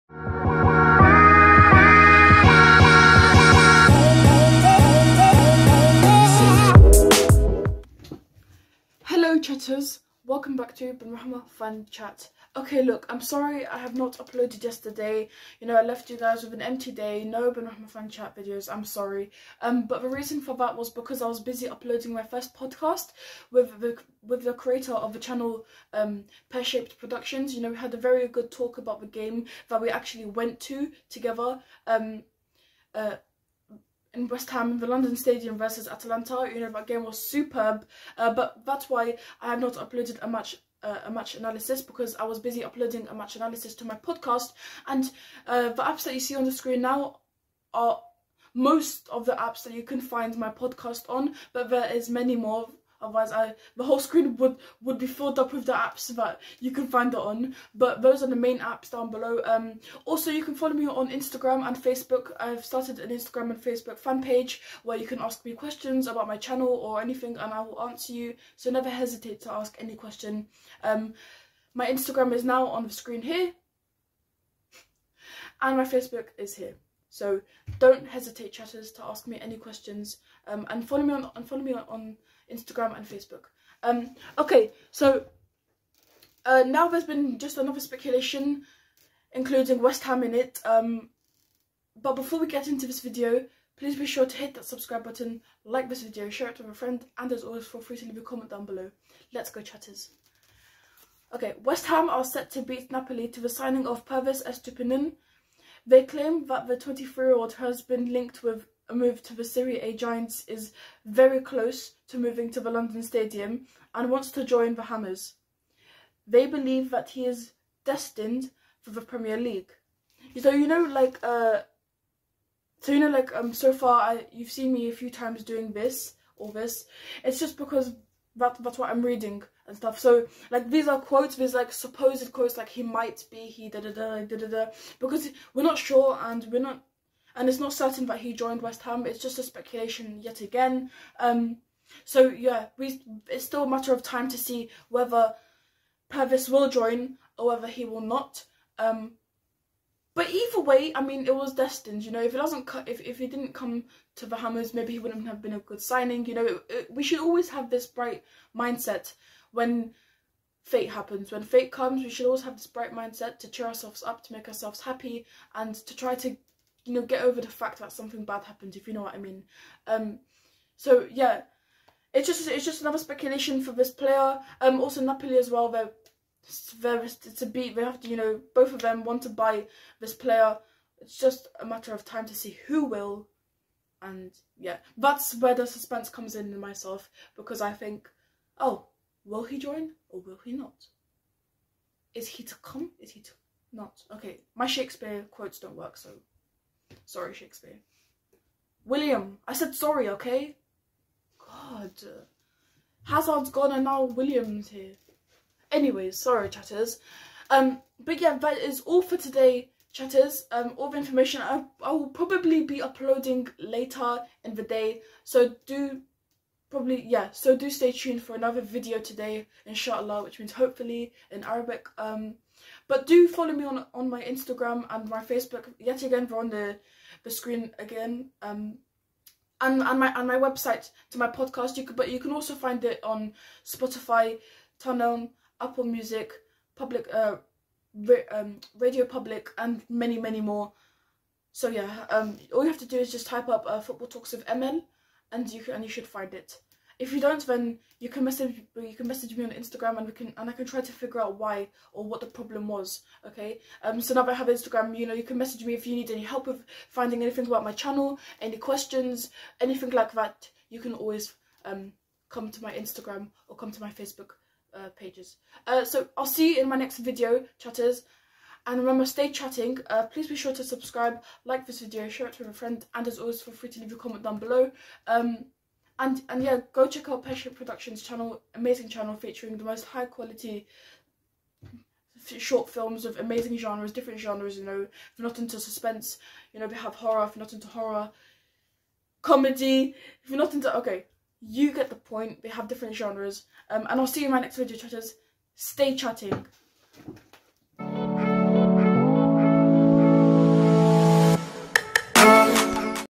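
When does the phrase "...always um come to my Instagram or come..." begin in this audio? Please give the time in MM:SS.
04:20.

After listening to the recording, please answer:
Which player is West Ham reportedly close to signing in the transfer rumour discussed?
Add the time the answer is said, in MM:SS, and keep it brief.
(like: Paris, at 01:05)
Pervis Estupinan, at 01:44.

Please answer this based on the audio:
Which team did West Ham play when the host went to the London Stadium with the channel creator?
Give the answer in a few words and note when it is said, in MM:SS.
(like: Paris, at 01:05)
Atalanta, at 00:35.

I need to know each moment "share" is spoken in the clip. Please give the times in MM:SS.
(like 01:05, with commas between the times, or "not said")
01:36, 04:32.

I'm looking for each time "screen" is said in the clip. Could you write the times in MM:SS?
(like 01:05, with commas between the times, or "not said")
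00:46, 00:53, 01:12, 03:47.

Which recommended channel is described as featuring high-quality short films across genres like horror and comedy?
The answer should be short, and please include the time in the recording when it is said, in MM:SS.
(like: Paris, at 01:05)
Passion Productions, at 04:37.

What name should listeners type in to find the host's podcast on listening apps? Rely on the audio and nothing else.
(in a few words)
Football Talks of Amel.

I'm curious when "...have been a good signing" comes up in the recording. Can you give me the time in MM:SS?
02:35.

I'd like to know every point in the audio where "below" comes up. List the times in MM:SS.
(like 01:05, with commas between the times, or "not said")
00:59, 01:38, 04:34.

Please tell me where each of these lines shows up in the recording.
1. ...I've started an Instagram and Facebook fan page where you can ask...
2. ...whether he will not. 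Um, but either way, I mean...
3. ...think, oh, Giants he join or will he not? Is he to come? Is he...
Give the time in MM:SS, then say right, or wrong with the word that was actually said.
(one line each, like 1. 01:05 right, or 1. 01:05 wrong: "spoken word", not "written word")
1. 01:02 right
2. 02:27 right
3. 03:07 wrong: "Will", not "Giants".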